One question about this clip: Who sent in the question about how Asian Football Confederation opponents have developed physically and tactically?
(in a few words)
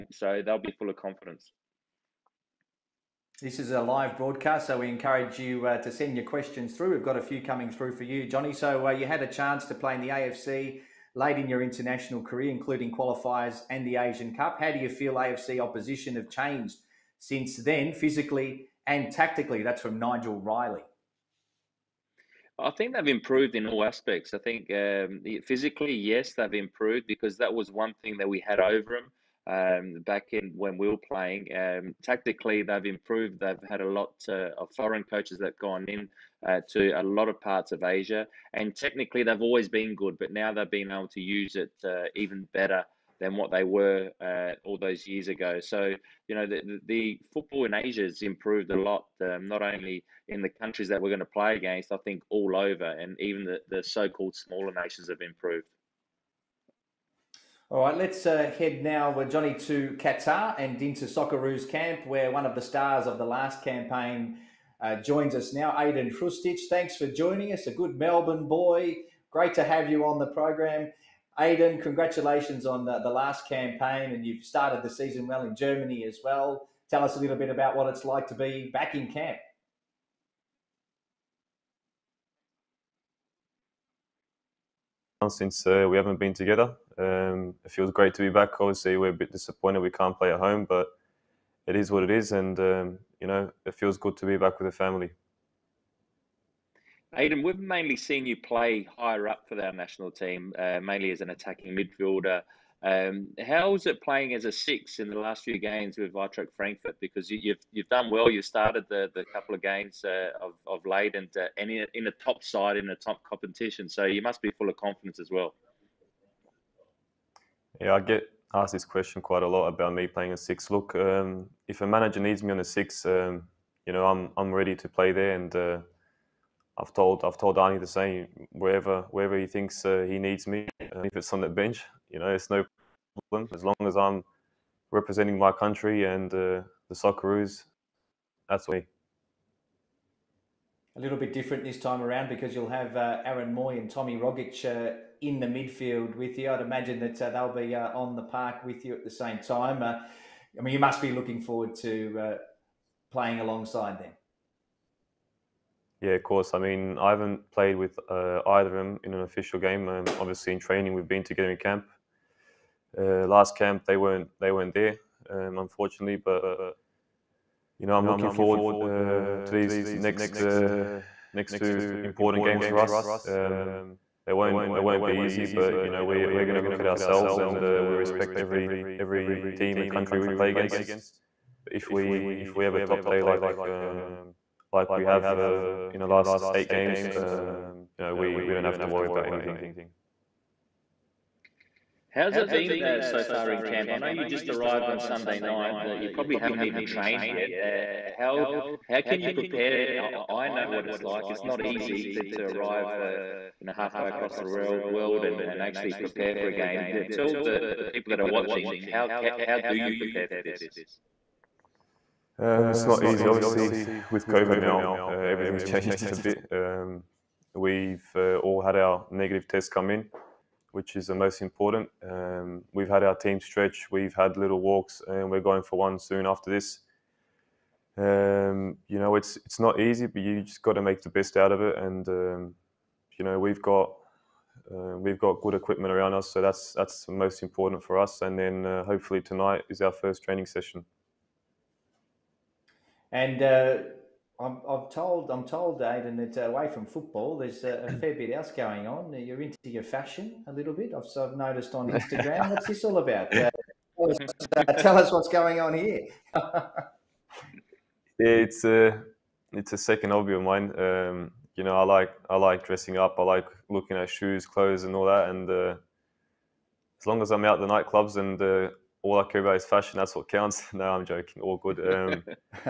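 Nigel Riley.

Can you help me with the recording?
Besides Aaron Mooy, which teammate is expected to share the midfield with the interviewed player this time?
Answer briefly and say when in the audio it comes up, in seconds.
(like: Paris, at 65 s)
Tommy Rogic, at 143 s.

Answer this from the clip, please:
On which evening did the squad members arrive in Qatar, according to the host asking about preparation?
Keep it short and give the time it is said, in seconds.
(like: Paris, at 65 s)
Sunday night, at 194 s.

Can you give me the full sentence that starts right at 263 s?
I like looking at shoes, clothes, and all that.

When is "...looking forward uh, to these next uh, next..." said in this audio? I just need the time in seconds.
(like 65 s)
168 s.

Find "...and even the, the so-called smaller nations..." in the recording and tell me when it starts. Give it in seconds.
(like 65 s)
52 s.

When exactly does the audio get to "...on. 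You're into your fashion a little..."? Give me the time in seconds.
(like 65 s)
248 s.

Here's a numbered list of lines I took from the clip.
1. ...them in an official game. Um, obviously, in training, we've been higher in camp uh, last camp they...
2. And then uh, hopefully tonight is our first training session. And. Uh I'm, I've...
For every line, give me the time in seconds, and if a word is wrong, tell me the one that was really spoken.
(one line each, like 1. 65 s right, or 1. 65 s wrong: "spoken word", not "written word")
1. 158 s wrong: "together", not "higher"
2. 238 s right.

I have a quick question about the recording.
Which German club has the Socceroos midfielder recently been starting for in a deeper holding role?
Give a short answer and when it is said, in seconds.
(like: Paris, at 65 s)
Eintracht Frankfurt, at 106 s.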